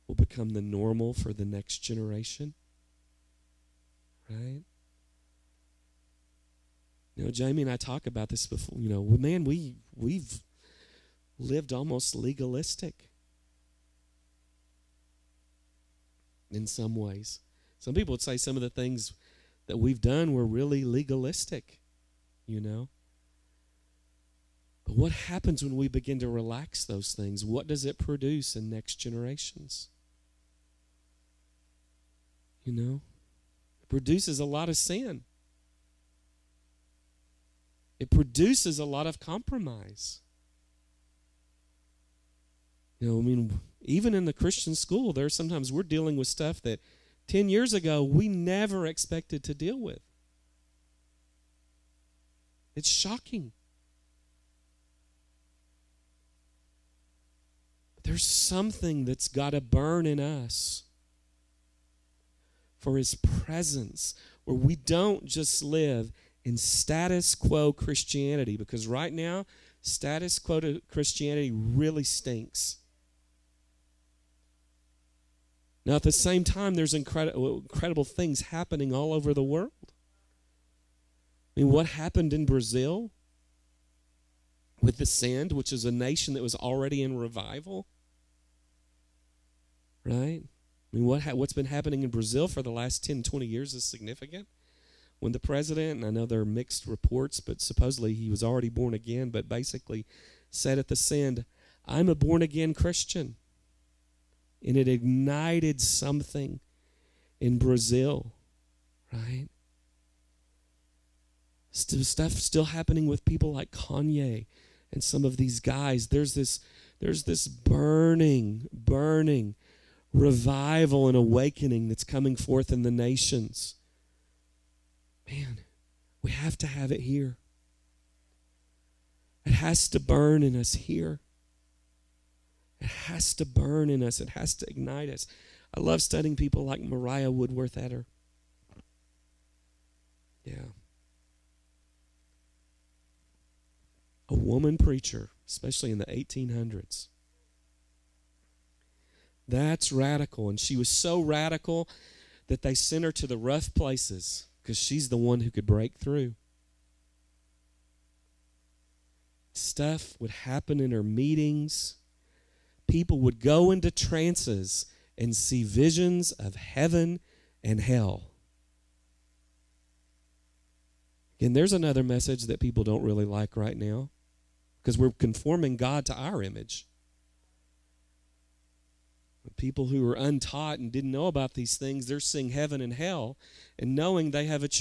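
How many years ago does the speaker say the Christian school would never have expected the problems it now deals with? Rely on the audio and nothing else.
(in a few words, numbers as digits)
10.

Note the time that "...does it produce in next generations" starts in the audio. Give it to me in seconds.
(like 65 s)
27 s.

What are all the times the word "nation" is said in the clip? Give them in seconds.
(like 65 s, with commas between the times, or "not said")
85 s, 122 s.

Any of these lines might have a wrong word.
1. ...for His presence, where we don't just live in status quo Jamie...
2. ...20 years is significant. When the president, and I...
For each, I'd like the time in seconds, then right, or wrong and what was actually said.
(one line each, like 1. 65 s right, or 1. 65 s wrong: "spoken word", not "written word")
1. 62 s wrong: "Christianity", not "Jamie"
2. 93 s right.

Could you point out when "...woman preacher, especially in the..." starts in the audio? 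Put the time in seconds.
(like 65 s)
144 s.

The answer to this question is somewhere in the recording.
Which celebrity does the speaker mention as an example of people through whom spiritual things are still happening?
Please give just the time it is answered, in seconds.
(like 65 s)
113 s.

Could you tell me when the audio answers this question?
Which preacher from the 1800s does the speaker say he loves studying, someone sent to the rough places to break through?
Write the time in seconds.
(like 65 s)
136 s.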